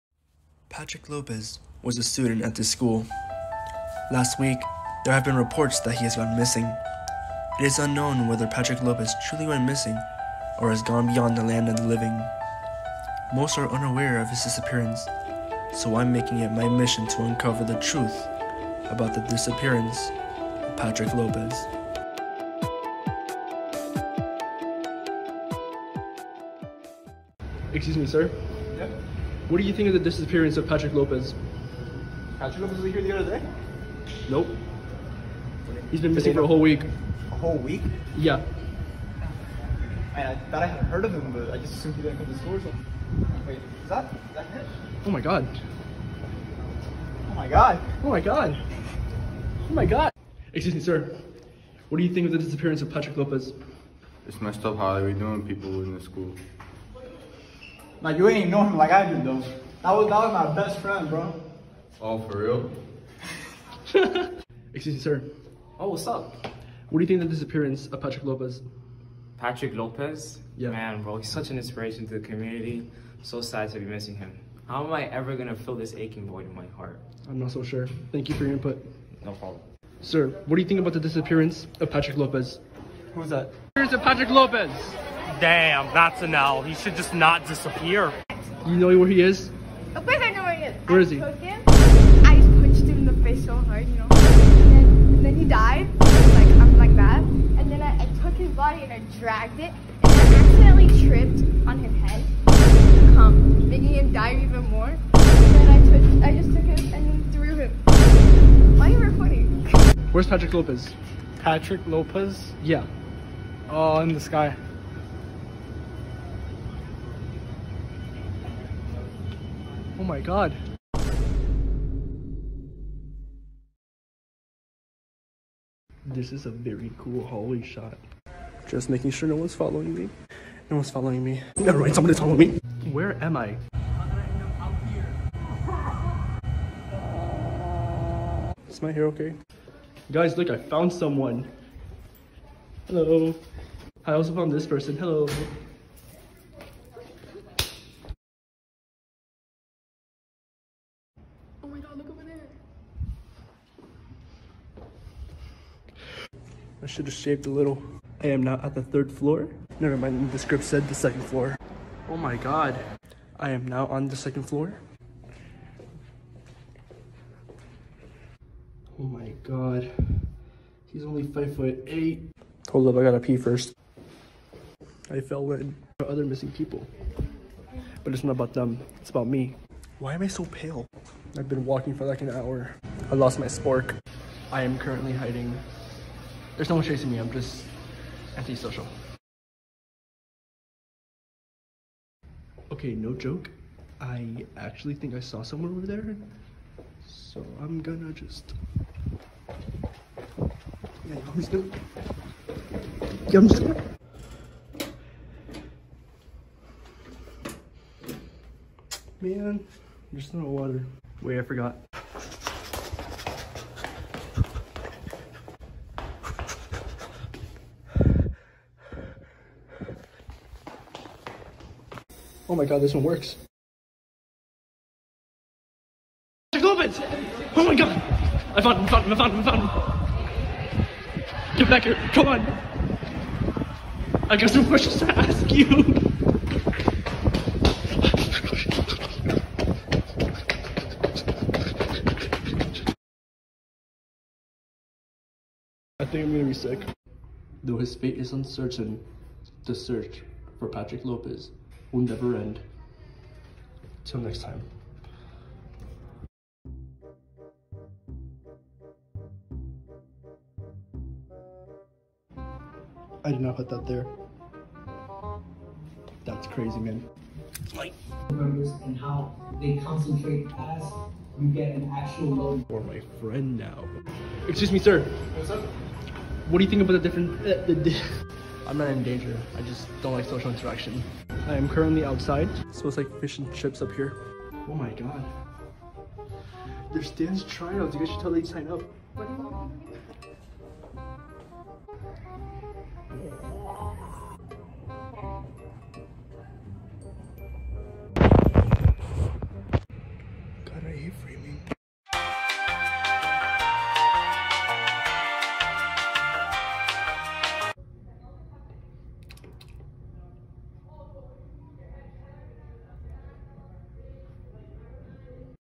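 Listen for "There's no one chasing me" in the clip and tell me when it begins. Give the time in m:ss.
3:06.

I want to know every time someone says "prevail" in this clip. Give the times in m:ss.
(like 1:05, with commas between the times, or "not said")
not said.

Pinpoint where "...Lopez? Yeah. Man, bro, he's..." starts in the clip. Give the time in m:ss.
1:09.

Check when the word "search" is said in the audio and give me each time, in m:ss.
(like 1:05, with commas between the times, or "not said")
4:09.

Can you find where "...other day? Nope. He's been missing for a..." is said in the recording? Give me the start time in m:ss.
0:33.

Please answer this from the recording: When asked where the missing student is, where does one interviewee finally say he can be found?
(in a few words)
in the sky.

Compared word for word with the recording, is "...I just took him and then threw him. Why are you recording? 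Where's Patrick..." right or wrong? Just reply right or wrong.
right.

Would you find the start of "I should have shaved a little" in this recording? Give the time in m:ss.
2:36.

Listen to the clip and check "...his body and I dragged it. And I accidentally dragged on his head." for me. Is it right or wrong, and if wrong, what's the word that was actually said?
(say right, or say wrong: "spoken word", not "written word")
wrong: "tripped", not "dragged".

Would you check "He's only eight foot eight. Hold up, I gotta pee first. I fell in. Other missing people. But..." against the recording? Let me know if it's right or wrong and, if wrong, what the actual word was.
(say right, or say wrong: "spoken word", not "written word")
wrong: "five", not "eight".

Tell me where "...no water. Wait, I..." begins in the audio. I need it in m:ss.
3:30.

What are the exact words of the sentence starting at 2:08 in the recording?
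Just making sure no one's following me.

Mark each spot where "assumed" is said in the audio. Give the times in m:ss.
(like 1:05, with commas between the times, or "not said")
0:41.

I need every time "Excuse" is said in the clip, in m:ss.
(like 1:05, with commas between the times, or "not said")
0:27, 0:50, 1:04, 4:34.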